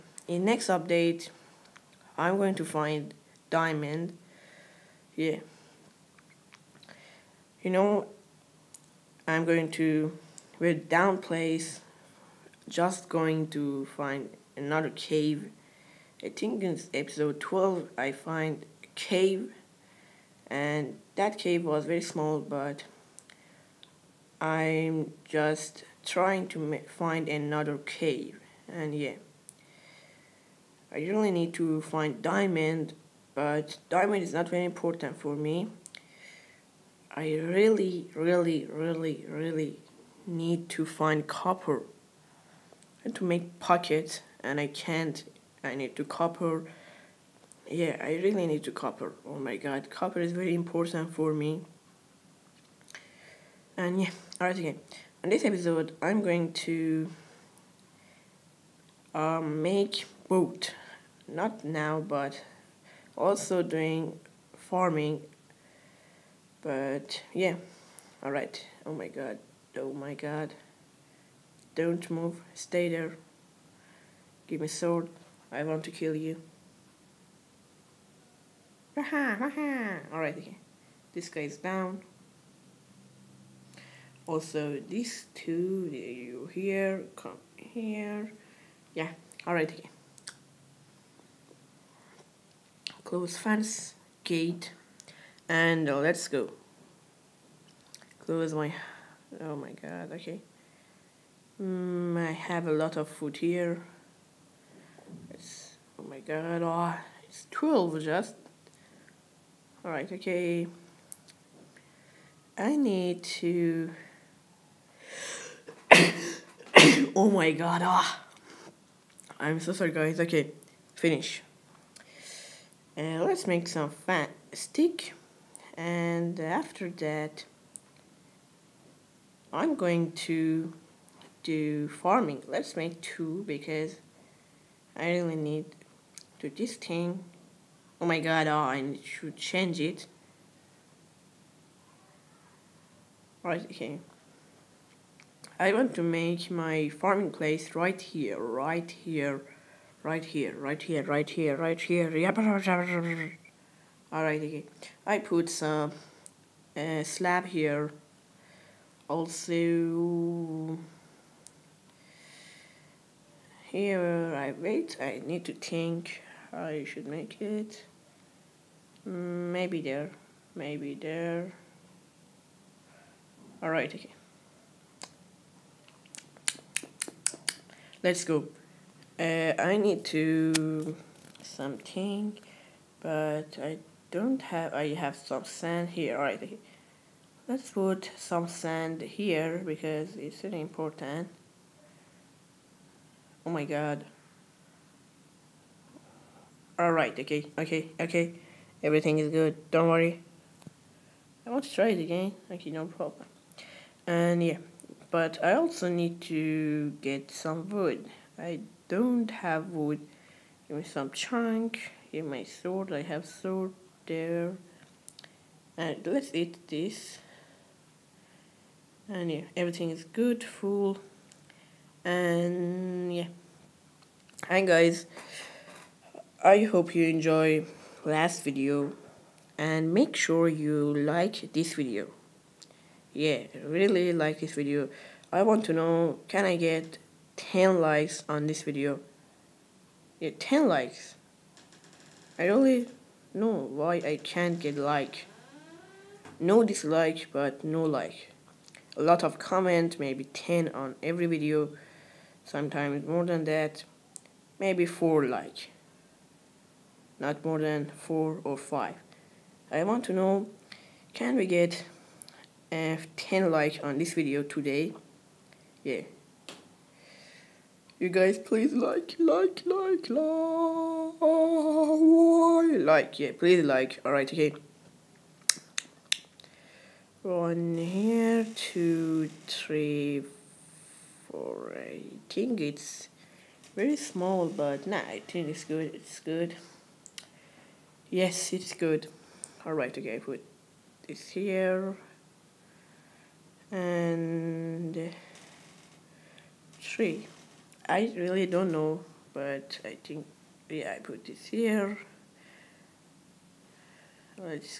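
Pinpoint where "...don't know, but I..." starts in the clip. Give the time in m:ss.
4:58.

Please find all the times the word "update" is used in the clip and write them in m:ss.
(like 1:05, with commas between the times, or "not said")
0:00.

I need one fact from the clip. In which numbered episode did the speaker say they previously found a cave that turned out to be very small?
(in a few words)
12.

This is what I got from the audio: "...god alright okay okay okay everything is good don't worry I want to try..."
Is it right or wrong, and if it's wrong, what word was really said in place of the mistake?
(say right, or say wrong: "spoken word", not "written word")
right.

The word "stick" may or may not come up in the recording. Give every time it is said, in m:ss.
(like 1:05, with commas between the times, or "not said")
2:04.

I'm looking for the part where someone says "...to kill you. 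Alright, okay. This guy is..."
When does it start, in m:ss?
1:15.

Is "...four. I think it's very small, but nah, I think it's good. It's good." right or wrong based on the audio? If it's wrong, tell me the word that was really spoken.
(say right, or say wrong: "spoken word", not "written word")
right.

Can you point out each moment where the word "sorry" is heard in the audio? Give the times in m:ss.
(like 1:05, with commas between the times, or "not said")
1:59.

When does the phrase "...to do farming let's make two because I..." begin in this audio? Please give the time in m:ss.
2:10.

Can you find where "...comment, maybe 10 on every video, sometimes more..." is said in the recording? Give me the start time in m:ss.
4:09.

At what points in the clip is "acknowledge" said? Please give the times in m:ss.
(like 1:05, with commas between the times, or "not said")
not said.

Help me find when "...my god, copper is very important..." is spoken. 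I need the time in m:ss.
0:49.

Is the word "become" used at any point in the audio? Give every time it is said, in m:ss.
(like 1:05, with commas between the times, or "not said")
not said.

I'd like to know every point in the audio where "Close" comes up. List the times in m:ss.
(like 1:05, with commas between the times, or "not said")
1:33, 1:38.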